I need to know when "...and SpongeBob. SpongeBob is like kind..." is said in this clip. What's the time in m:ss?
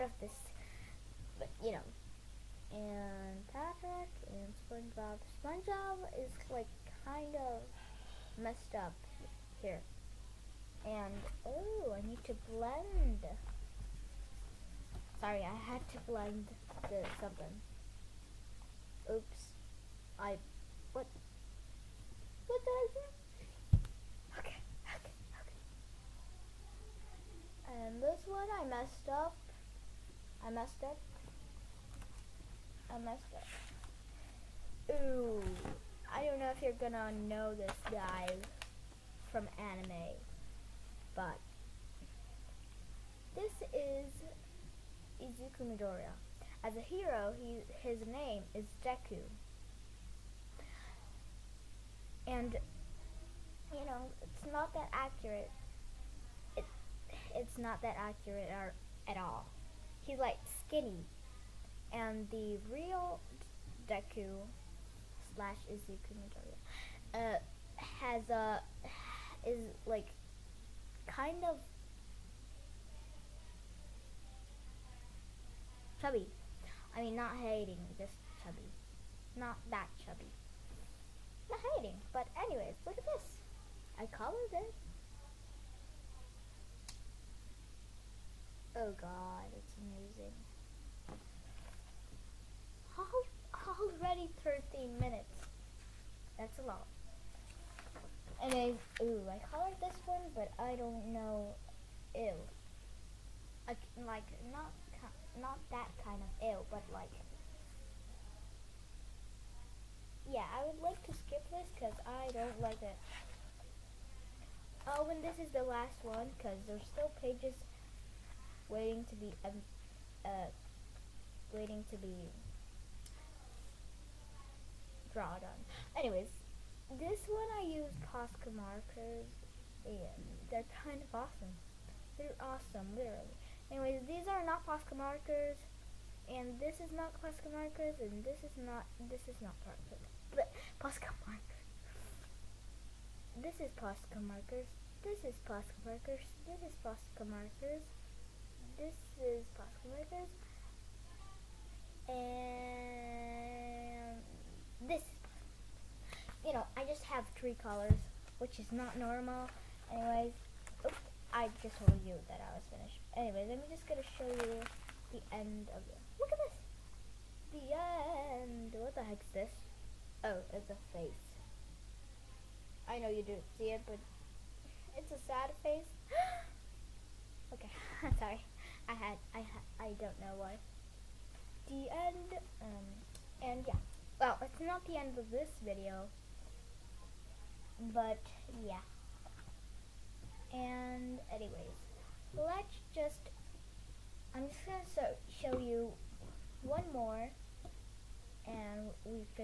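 0:04.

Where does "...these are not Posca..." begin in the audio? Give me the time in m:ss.
2:14.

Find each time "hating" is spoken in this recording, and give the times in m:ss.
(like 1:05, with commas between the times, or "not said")
1:17, 1:21.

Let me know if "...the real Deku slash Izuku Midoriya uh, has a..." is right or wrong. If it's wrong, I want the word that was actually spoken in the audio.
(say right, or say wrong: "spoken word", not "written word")
right.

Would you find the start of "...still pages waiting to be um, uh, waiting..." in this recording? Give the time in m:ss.
1:56.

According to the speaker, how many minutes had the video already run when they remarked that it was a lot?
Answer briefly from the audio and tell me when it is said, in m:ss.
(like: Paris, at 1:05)
13, at 1:34.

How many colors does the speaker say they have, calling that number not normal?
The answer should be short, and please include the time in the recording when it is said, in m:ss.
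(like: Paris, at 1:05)
3, at 2:37.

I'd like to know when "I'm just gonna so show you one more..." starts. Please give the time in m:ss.
3:14.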